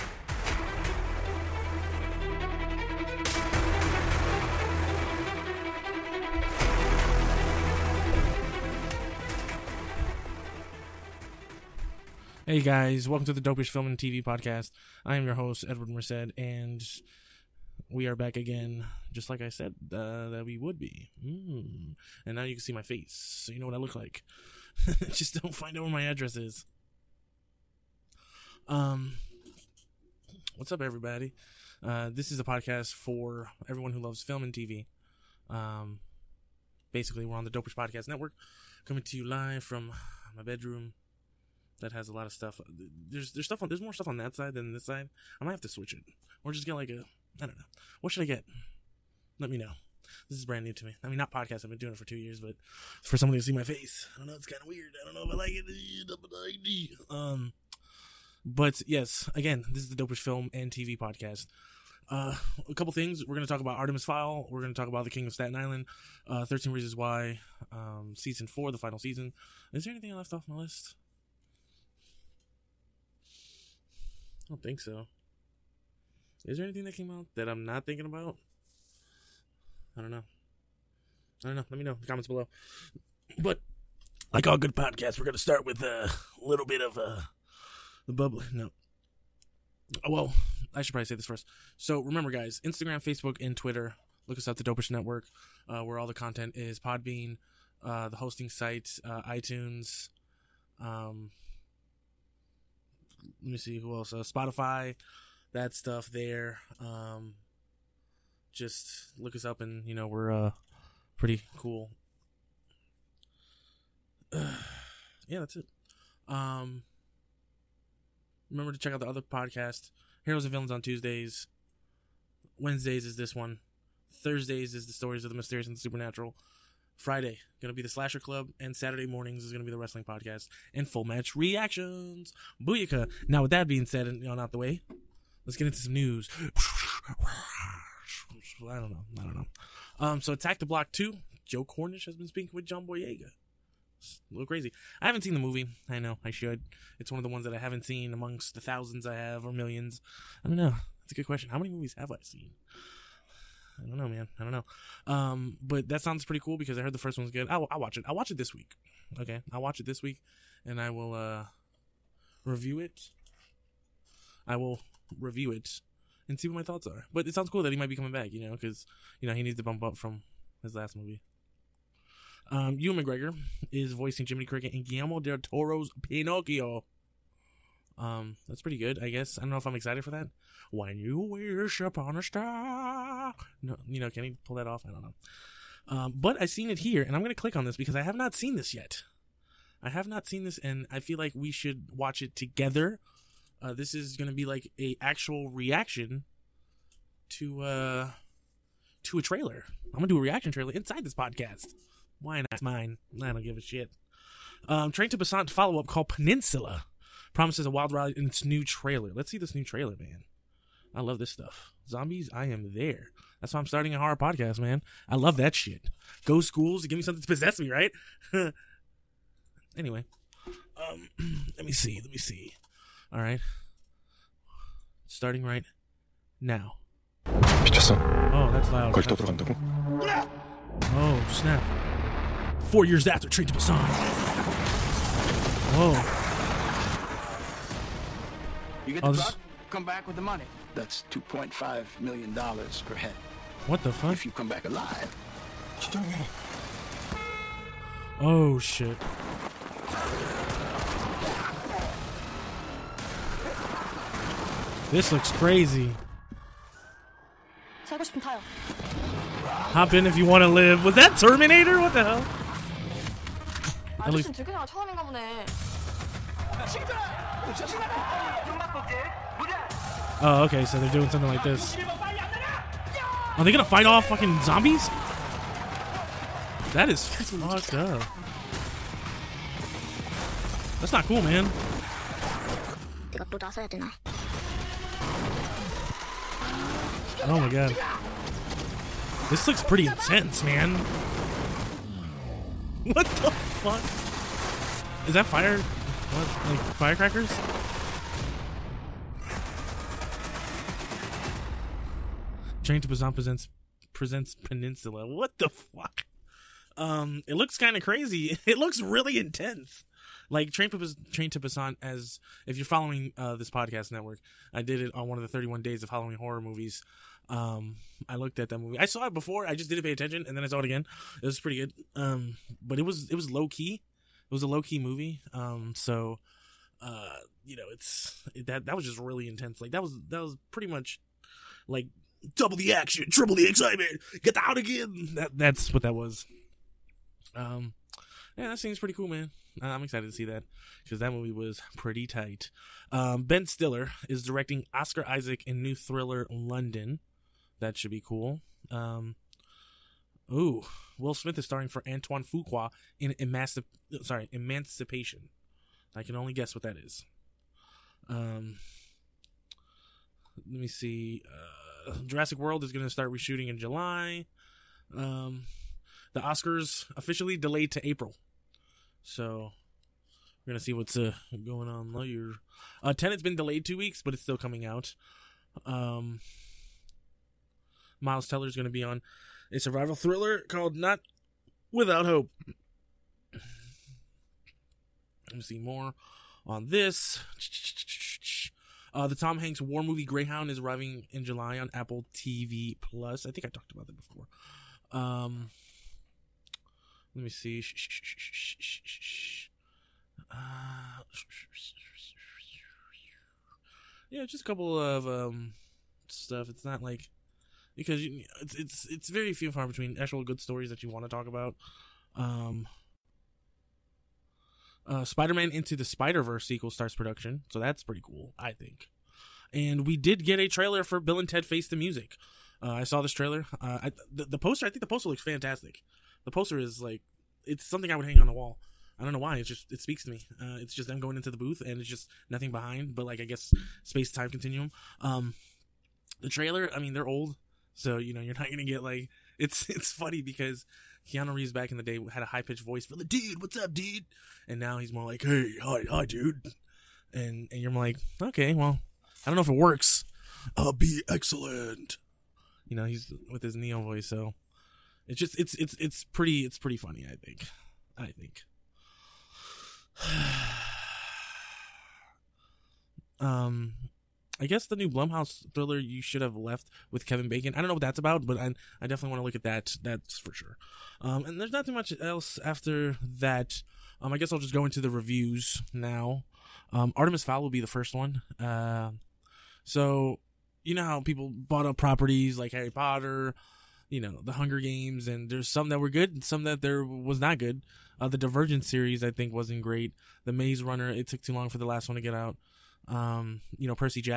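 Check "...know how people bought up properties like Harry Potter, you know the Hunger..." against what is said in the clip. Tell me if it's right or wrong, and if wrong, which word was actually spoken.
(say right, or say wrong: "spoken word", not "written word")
right.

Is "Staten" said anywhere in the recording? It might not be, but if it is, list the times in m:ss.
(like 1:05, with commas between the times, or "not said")
1:05.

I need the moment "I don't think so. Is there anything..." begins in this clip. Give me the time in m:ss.
1:14.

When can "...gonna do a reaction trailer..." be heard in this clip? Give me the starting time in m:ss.
3:19.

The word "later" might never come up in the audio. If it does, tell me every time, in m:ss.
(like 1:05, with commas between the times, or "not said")
6:11.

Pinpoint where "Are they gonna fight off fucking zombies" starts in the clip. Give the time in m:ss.
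4:33.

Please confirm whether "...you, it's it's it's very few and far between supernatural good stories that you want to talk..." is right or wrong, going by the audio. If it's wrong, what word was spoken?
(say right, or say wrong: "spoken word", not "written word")
wrong: "actual", not "supernatural".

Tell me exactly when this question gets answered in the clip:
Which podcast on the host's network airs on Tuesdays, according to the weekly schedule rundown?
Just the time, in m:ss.
2:00.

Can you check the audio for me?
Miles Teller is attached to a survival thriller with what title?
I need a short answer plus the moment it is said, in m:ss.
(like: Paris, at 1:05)
Not Without Hope, at 6:20.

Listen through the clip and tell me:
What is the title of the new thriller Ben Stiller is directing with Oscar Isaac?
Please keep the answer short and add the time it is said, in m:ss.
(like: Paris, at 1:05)
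London, at 5:46.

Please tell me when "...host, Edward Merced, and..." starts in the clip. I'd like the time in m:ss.
0:15.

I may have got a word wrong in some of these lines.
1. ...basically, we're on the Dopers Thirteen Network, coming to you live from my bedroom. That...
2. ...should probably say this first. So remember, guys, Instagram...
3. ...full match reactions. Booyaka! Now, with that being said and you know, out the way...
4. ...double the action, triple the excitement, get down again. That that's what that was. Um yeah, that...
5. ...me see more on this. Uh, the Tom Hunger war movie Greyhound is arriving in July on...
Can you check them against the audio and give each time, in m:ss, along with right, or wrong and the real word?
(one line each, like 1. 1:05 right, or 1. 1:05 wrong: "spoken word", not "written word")
1. 0:36 wrong: "Podcast", not "Thirteen"
2. 1:30 right
3. 2:10 right
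4. 5:32 right
5. 6:25 wrong: "Hanks", not "Hunger".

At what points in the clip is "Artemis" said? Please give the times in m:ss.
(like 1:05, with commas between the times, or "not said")
1:03, 7:56.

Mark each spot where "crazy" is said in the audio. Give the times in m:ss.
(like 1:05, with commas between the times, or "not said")
2:24, 4:15, 5:07.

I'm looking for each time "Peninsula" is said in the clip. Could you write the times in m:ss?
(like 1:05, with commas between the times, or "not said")
3:26, 5:04.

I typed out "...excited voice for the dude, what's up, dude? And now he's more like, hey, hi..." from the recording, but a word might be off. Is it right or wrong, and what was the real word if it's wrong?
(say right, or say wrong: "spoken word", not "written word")
wrong: "pitched", not "excited".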